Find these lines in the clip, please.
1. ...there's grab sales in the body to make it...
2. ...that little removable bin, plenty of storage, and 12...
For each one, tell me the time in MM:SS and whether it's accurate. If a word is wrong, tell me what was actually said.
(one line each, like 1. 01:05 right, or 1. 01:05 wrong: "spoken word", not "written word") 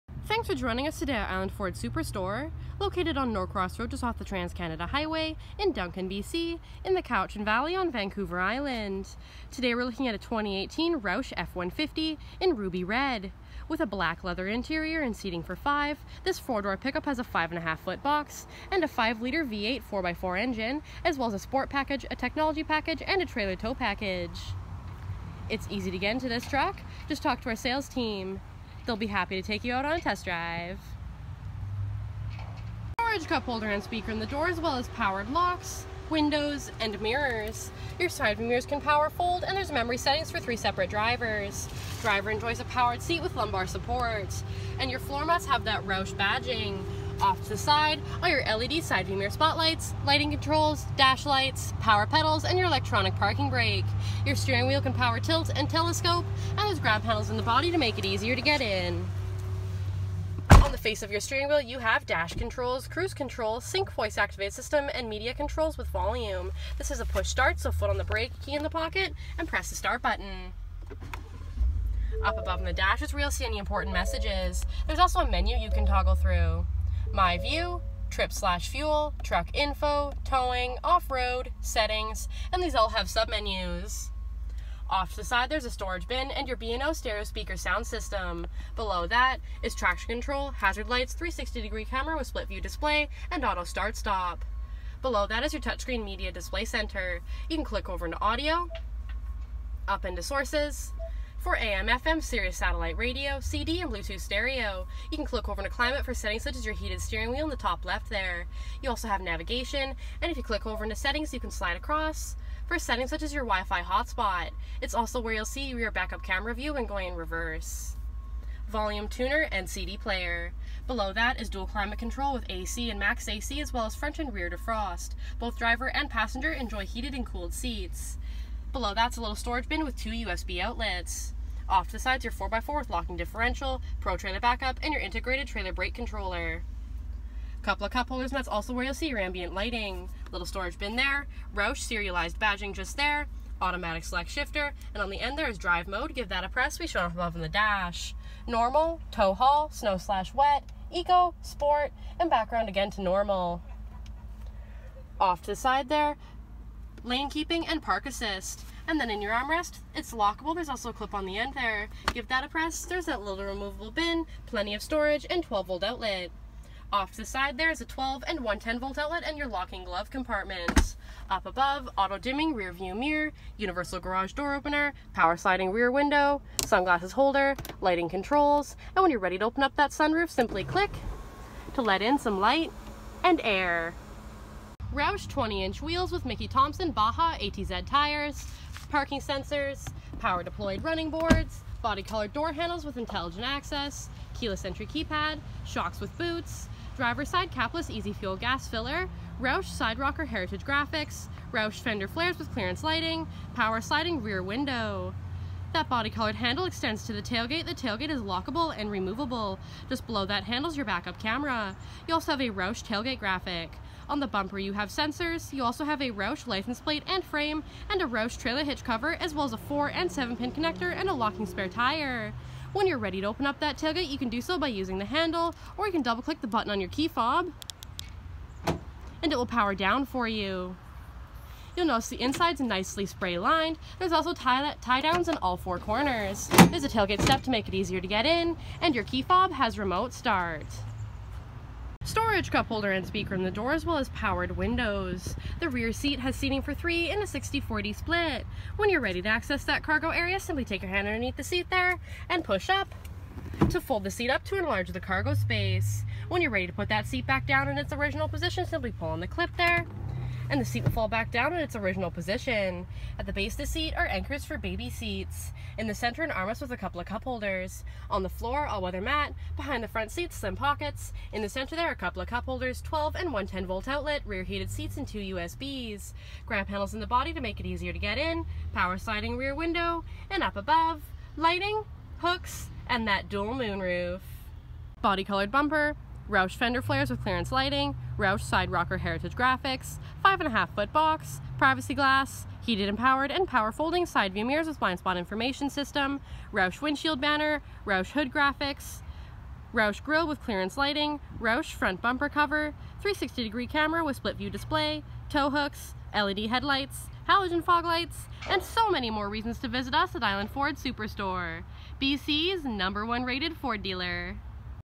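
1. 00:56 wrong: "handles", not "sales"
2. 02:43 right.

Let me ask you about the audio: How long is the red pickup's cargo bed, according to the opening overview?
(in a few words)
5.5 feet.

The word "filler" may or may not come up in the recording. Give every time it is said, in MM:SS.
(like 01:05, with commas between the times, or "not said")
03:18.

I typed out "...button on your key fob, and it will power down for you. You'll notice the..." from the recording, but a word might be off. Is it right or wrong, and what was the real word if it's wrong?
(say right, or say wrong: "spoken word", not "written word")
right.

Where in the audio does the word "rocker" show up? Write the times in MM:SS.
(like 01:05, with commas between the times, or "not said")
03:19, 04:48.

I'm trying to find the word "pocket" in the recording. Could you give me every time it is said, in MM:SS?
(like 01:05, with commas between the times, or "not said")
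01:08, 04:30.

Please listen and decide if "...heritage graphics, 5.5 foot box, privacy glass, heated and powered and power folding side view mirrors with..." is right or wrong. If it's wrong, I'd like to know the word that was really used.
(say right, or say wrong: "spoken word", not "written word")
right.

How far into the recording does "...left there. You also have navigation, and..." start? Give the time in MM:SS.
01:47.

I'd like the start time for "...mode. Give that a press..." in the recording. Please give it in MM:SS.
02:25.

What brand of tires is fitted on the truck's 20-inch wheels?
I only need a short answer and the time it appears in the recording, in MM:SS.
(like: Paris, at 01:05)
Mickey Thompson, at 03:06.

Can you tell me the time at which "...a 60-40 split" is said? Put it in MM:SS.
04:07.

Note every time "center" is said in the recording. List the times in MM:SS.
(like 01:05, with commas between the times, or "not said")
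01:36, 04:25, 04:31.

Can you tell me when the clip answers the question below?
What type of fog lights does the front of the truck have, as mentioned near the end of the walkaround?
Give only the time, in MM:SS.
05:07.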